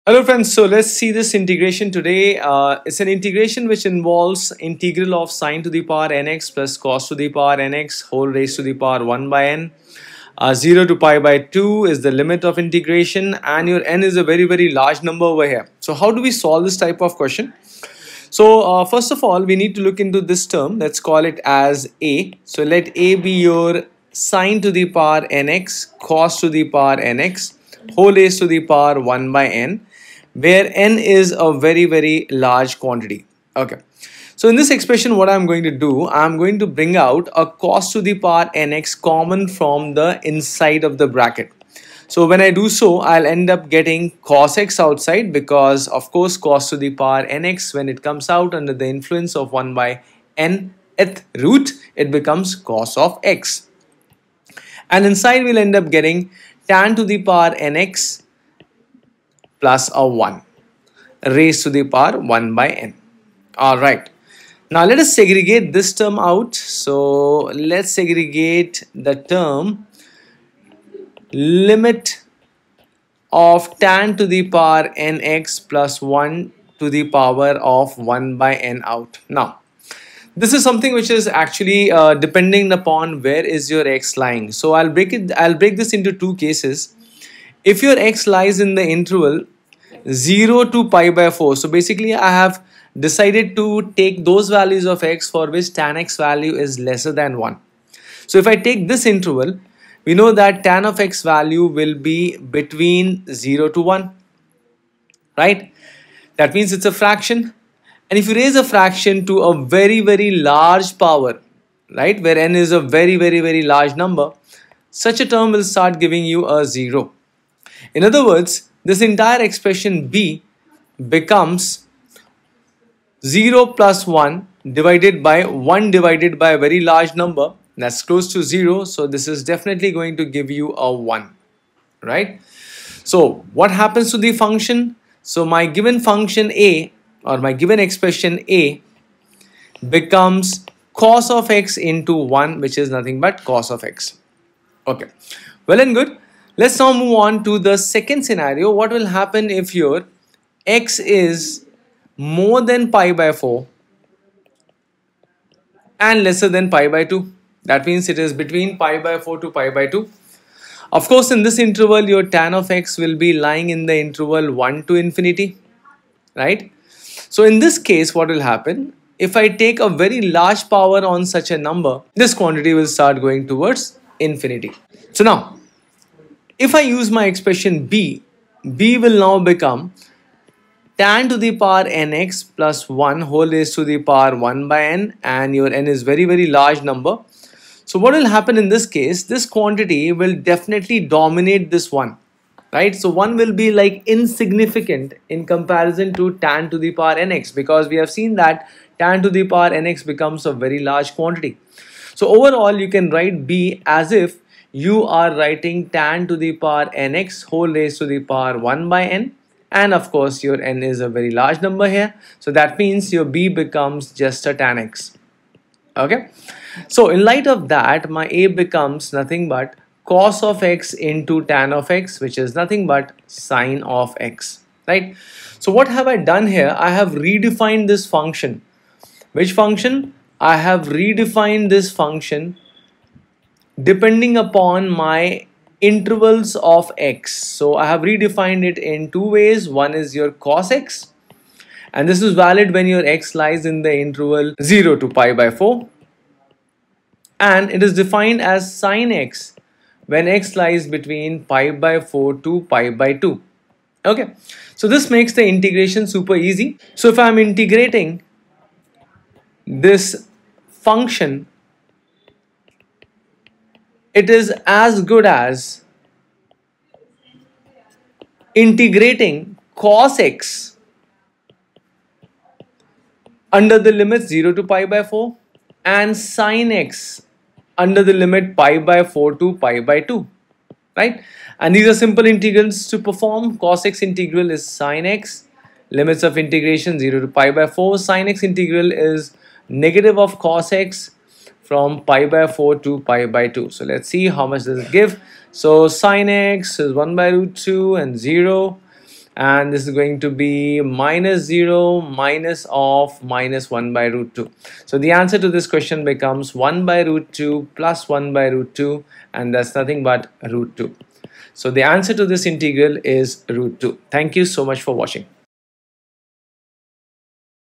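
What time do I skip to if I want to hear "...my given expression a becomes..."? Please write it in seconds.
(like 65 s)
137 s.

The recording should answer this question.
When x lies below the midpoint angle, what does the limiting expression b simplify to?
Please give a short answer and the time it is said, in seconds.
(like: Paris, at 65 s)
1, at 129 s.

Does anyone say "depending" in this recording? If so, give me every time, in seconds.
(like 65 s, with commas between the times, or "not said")
82 s, 233 s.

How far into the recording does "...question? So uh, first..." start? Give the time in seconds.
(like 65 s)
17 s.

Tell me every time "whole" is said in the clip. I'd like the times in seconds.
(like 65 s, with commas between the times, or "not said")
8 s, 27 s, 183 s, 207 s.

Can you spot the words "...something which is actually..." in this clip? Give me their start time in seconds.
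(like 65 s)
80 s.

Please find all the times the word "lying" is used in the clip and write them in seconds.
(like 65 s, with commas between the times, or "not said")
84 s, 163 s.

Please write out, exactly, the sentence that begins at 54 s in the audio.
And inside we'll end up getting tan to the power nx plus a 1 raised to the power 1 by n.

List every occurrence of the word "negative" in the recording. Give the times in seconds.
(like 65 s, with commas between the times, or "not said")
289 s.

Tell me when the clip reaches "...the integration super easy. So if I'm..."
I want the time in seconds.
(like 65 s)
255 s.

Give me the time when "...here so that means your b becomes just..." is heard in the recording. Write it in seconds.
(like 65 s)
211 s.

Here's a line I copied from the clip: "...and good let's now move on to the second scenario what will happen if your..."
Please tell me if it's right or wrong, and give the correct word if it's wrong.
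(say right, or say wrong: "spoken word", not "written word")
right.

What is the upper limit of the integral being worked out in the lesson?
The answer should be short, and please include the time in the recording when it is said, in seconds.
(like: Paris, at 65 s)
pi/2, at 10 s.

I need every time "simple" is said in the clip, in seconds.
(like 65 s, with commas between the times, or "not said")
282 s.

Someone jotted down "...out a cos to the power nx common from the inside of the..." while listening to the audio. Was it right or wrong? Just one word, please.
right.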